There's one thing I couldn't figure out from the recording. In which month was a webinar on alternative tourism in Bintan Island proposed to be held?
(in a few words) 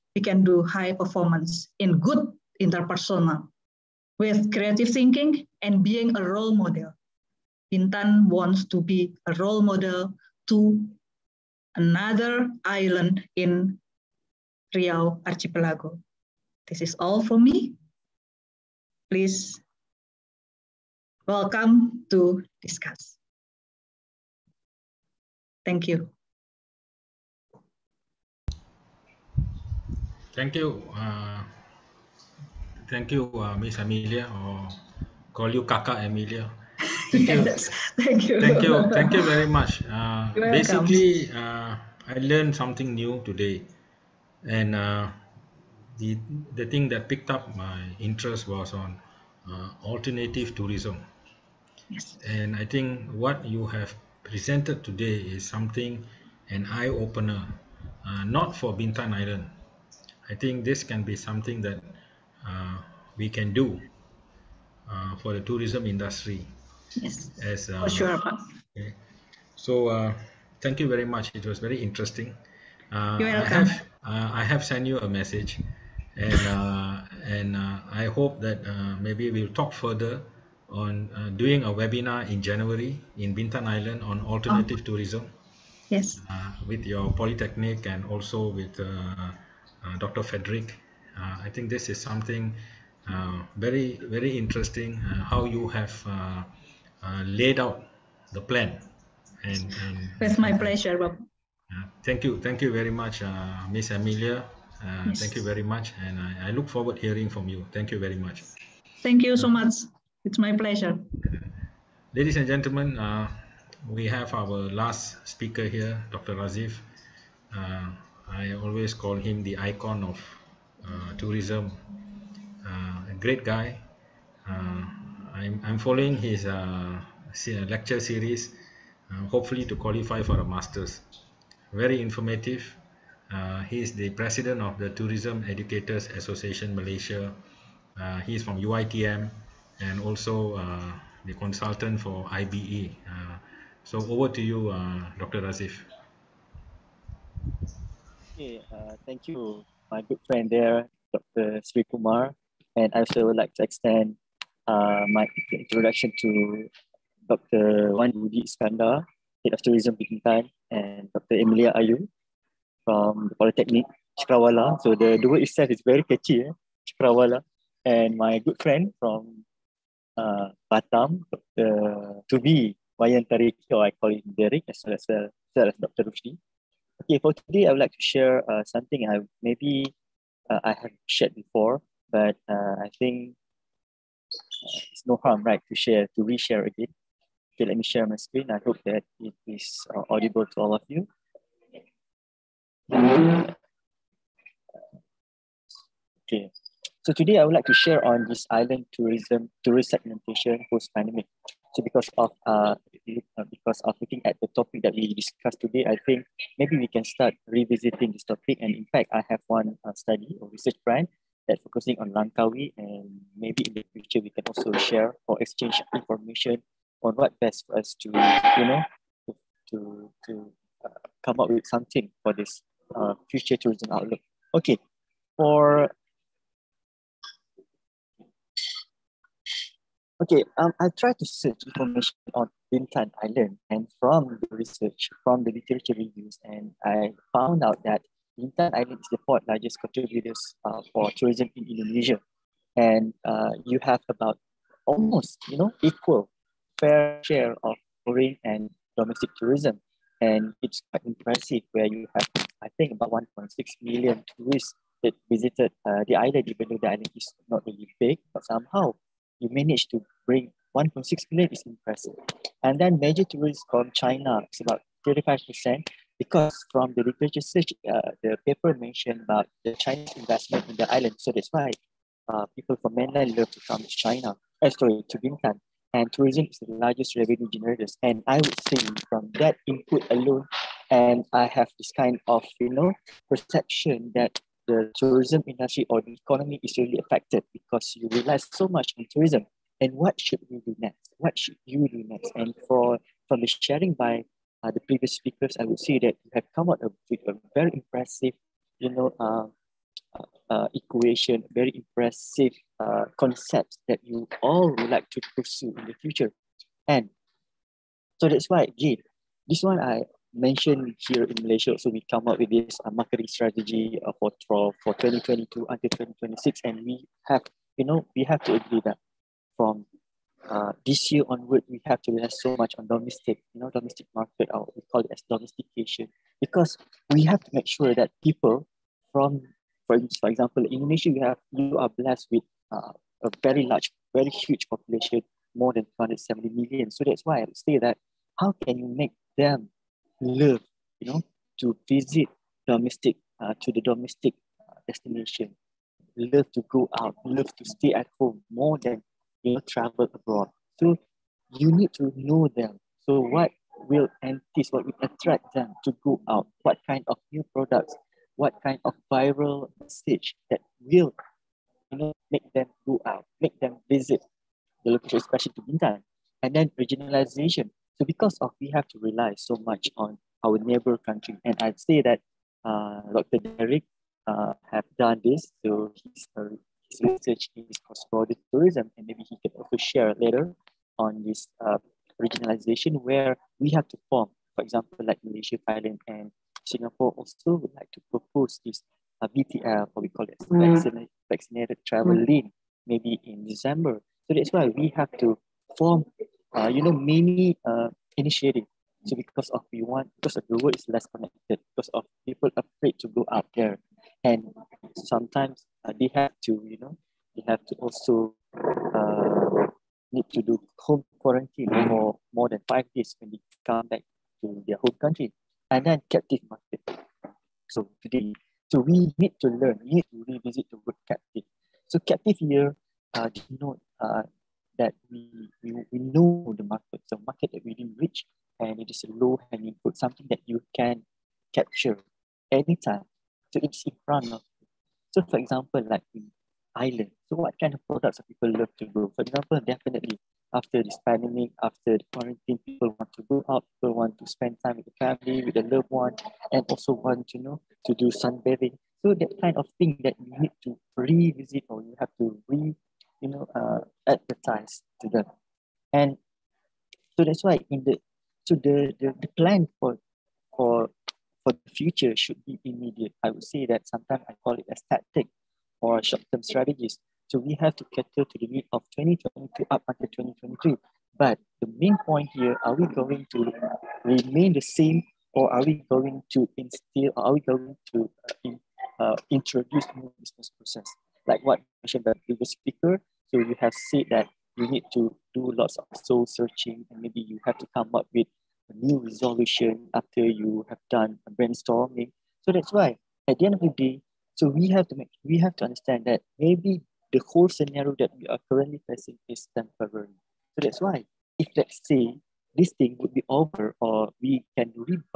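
January.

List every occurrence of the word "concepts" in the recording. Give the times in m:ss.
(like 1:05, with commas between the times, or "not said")
5:03.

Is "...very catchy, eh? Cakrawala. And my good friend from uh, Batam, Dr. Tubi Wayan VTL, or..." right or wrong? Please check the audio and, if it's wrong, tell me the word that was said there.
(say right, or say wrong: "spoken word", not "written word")
wrong: "Tariki", not "VTL".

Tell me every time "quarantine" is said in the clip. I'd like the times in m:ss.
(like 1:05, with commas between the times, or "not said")
6:51, 7:22.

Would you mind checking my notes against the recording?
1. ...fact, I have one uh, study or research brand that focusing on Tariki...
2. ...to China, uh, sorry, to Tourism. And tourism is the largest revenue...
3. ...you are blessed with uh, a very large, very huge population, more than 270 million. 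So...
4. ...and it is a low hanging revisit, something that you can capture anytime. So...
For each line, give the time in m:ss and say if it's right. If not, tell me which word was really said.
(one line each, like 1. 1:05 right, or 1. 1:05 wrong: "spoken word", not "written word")
1. 3:28 wrong: "Langkawi", not "Tariki"
2. 4:33 wrong: "Bintan", not "Tourism"
3. 5:31 right
4. 7:08 wrong: "fruit", not "revisit".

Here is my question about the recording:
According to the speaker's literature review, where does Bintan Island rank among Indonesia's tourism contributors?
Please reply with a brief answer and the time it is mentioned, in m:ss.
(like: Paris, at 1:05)
fourth largest, at 3:59.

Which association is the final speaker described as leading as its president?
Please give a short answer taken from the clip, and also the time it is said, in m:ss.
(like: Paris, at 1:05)
Tourism Educators Association Malaysia, at 2:14.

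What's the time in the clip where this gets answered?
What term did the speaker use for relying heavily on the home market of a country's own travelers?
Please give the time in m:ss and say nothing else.
5:25.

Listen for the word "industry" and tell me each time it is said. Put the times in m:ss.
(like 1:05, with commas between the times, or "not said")
1:05, 4:45.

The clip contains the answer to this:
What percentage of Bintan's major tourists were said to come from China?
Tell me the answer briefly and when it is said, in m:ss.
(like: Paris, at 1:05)
35%, at 4:25.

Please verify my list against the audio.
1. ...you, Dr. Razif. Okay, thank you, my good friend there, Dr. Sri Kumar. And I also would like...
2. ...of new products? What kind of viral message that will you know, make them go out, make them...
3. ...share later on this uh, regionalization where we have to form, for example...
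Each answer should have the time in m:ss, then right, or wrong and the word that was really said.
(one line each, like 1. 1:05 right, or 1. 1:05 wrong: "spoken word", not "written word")
1. 2:24 right
2. 5:57 right
3. 6:19 right.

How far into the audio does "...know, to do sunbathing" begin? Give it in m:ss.
7:27.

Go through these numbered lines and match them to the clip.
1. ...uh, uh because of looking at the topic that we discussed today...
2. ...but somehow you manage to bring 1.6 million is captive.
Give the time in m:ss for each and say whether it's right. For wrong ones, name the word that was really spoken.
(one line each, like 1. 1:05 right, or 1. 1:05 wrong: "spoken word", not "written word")
1. 3:22 right
2. 4:18 wrong: "impressive", not "captive".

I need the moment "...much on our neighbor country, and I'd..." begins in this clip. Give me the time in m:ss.
6:09.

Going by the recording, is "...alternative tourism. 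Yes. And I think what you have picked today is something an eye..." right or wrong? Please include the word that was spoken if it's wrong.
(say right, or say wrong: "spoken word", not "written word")
wrong: "presented", not "picked".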